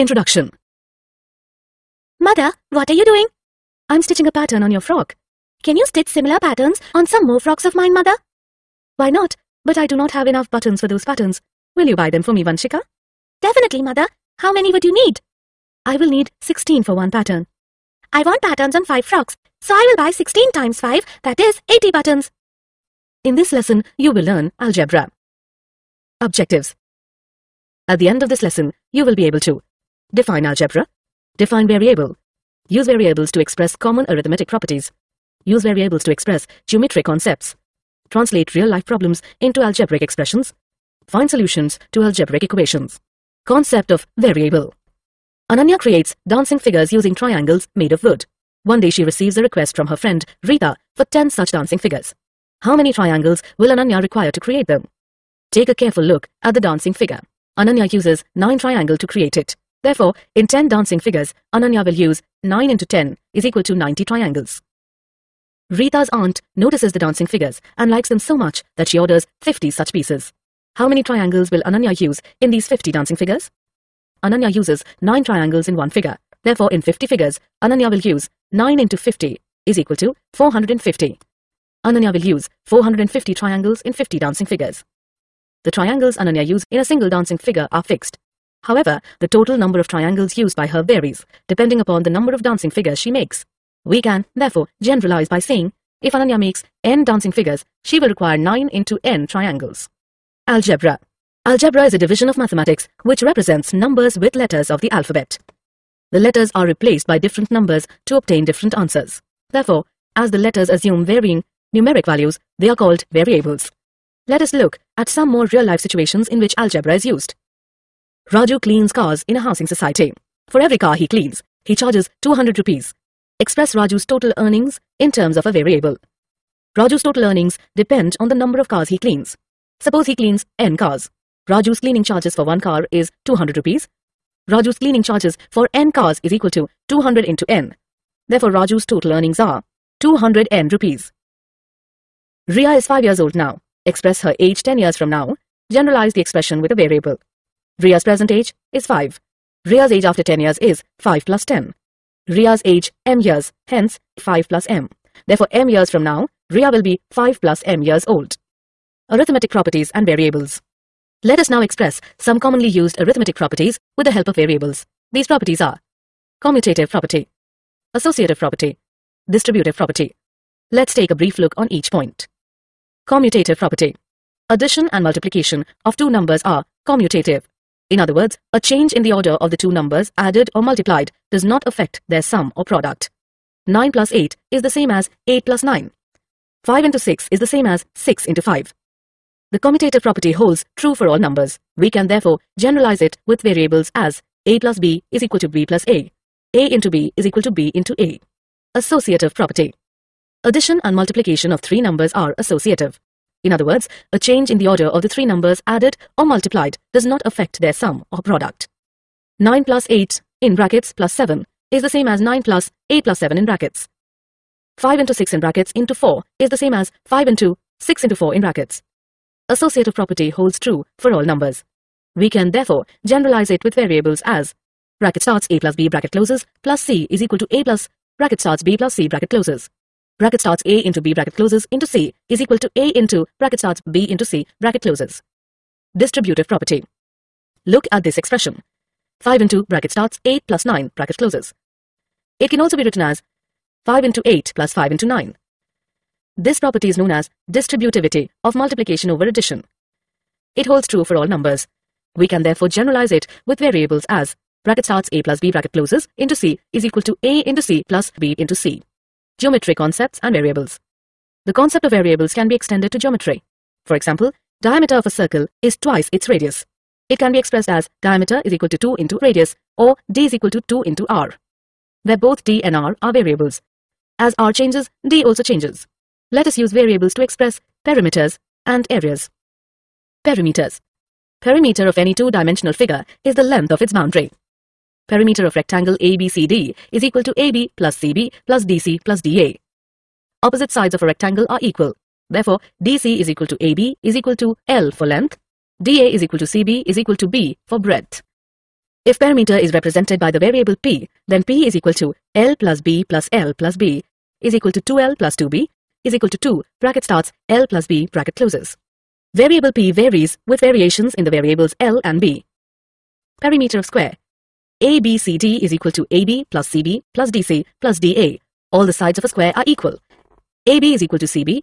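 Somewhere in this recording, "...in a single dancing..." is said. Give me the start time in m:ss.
1:26.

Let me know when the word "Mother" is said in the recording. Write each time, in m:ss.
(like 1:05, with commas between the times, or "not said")
0:02, 0:07, 0:13.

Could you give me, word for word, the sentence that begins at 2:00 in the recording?
For every car he cleans, he charges 200 rupees.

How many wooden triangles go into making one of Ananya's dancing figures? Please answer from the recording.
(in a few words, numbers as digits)
9.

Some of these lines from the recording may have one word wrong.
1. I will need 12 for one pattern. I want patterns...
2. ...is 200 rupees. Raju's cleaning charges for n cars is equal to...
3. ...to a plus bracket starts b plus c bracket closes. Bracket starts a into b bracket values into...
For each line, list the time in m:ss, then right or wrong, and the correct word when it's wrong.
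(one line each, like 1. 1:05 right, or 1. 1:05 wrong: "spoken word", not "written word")
1. 0:15 wrong: "16", not "12"
2. 2:12 right
3. 3:47 wrong: "closes", not "values".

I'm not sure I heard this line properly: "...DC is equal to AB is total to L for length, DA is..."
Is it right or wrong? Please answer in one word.
wrong.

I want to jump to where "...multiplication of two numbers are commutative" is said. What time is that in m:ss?
2:55.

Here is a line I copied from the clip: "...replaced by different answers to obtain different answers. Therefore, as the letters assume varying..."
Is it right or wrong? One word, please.
wrong.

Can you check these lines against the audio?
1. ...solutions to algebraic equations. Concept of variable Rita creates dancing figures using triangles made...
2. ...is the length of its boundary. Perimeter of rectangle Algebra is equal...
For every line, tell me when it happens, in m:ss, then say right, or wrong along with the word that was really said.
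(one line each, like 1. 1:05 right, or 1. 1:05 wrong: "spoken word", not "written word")
1. 0:41 wrong: "Ananya", not "Rita"
2. 4:43 wrong: "ABCD", not "Algebra".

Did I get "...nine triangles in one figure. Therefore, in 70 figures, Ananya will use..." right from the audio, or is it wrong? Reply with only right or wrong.
wrong.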